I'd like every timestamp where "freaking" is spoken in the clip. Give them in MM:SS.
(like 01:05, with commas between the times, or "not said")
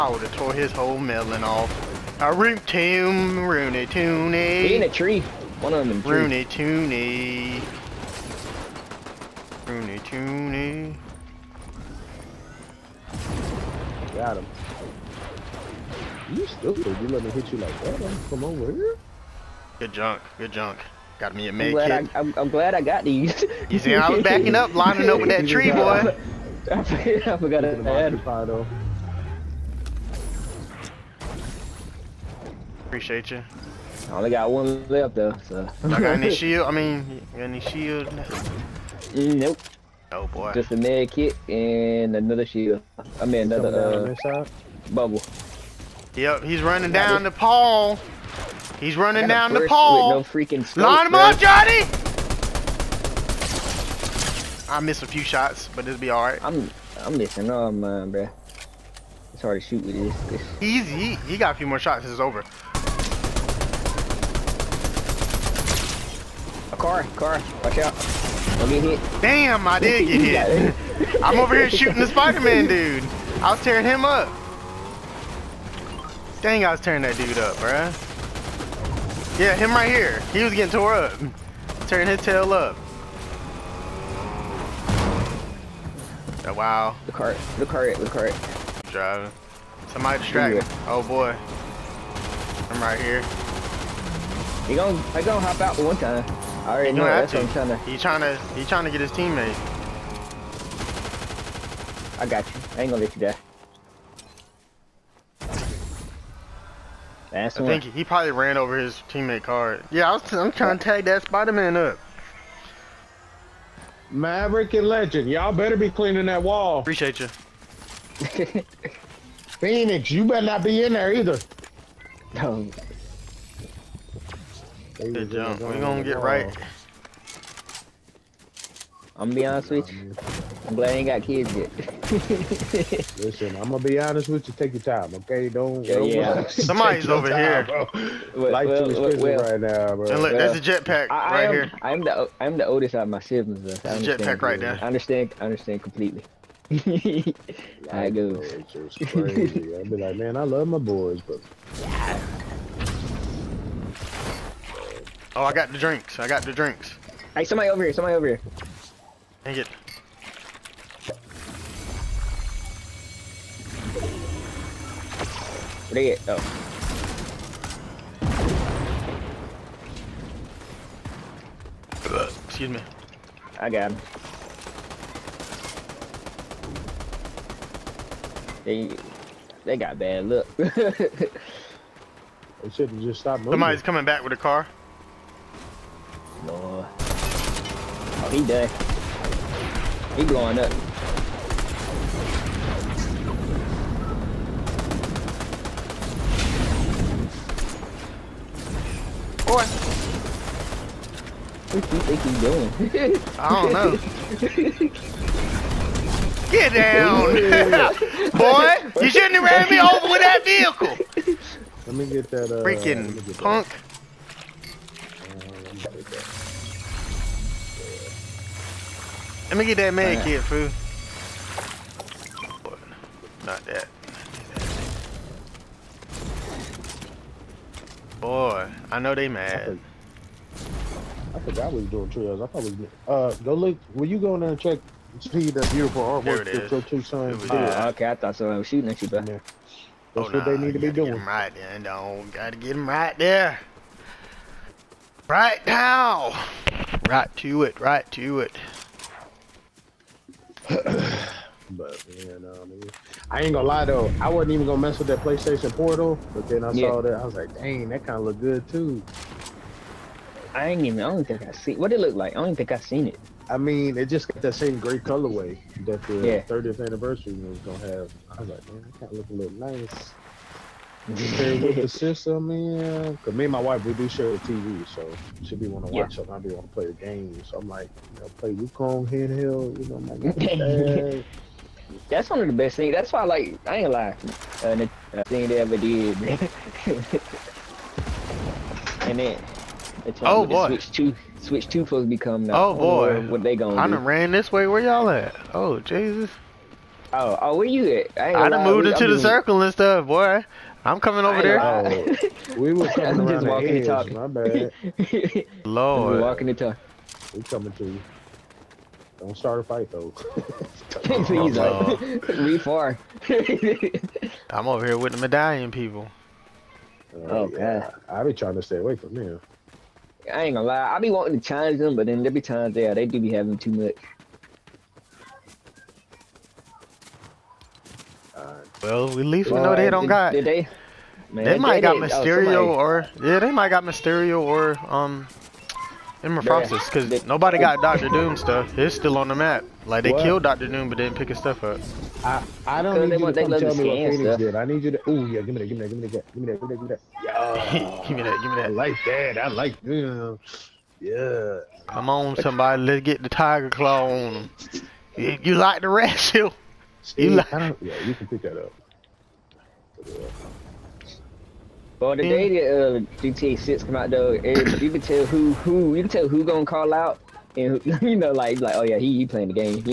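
00:50, 03:32.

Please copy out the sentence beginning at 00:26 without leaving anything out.
I forgot, I forgot to add though.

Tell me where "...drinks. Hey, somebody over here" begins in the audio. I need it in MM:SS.
02:36.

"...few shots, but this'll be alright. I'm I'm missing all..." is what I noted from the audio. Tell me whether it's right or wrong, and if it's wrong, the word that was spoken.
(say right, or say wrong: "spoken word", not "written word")
right.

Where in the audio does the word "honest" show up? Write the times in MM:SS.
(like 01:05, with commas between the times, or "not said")
02:09, 02:13.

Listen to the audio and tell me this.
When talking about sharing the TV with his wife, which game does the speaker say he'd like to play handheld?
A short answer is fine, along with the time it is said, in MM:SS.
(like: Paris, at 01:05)
Wukong, at 04:38.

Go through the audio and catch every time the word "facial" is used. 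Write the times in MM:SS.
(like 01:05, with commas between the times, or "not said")
not said.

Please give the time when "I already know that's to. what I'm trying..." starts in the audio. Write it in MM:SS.
01:36.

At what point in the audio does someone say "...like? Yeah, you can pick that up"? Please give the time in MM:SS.
05:57.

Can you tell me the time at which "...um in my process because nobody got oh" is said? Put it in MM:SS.
05:34.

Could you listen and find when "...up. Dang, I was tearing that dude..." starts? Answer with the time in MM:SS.
01:14.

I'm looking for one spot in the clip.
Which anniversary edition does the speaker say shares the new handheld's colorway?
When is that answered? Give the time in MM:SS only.
04:26.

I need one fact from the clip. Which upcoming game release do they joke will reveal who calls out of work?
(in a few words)
GTA 6.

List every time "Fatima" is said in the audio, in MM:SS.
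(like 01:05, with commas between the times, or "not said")
not said.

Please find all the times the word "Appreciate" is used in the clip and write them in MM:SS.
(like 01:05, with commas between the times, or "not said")
00:32, 01:56.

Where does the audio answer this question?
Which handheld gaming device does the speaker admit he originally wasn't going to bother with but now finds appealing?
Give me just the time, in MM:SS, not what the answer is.
04:15.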